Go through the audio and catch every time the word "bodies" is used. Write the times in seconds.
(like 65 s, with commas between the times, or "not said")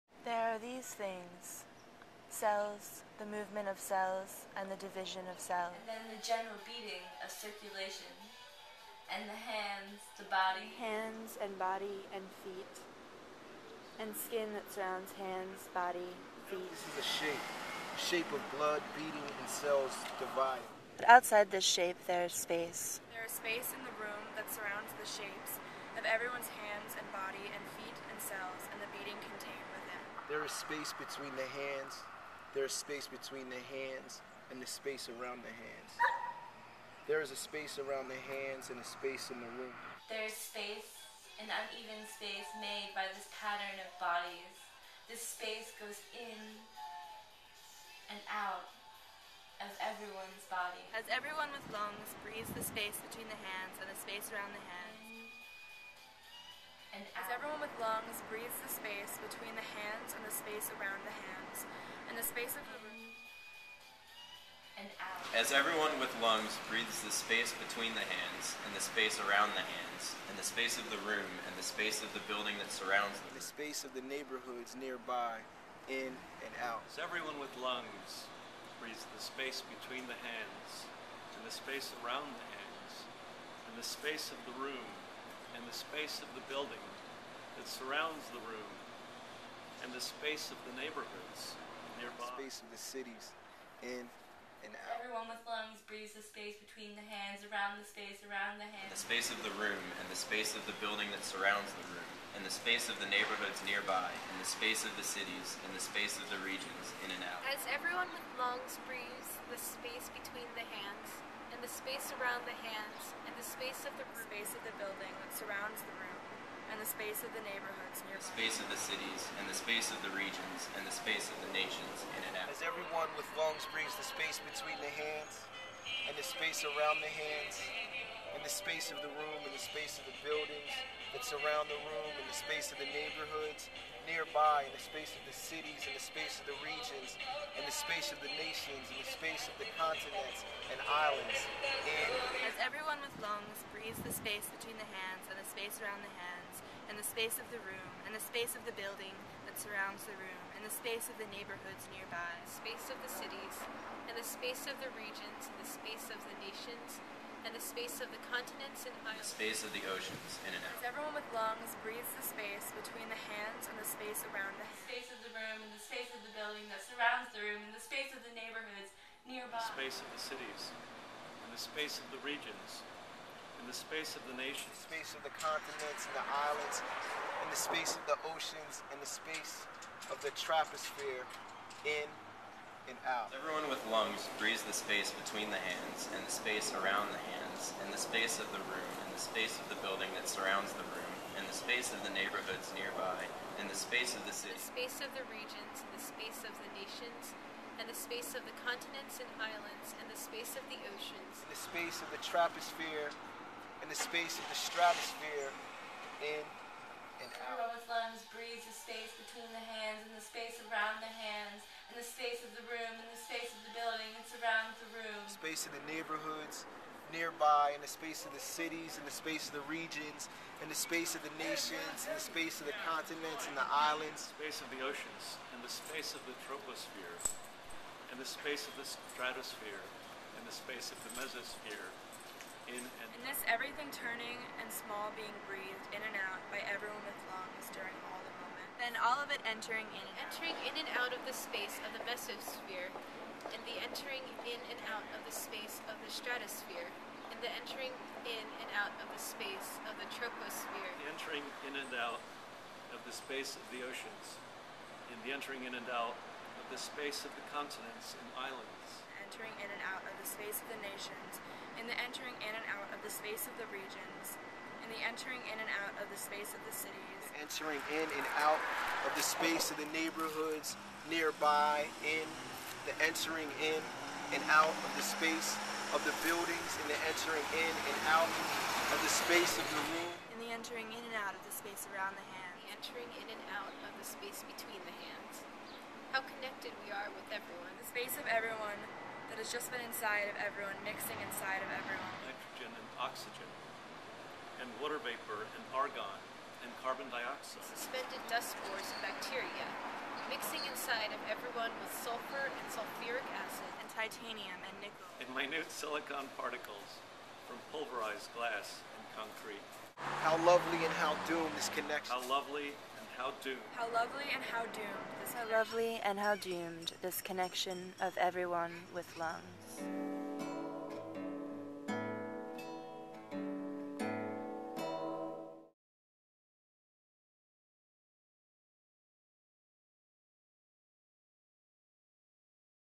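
43 s.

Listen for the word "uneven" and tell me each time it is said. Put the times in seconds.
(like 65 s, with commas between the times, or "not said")
41 s.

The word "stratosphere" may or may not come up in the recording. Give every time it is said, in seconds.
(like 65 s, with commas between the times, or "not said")
204 s, 228 s, 246 s.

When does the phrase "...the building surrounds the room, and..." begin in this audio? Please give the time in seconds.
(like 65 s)
114 s.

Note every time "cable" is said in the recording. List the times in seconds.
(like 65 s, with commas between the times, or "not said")
not said.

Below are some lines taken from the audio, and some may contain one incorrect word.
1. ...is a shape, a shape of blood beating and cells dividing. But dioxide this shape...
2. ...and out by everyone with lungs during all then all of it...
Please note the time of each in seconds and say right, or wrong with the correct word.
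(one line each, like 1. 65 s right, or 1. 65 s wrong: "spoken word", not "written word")
1. 16 s wrong: "outside", not "dioxide"
2. 236 s right.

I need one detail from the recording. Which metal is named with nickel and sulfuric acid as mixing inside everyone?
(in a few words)
titanium.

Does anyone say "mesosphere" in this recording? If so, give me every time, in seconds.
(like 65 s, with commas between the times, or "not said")
231 s, 242 s.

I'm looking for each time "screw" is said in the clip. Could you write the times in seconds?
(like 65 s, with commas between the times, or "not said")
not said.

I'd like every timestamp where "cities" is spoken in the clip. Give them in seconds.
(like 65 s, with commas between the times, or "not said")
92 s, 105 s, 118 s, 135 s, 153 s, 170 s, 218 s, 266 s.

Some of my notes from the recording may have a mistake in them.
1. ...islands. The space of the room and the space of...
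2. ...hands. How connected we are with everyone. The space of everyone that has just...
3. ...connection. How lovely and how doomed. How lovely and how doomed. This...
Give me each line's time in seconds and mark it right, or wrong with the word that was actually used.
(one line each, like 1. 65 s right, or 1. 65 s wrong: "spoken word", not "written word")
1. 98 s wrong: "hands", not "islands"
2. 285 s right
3. 311 s right.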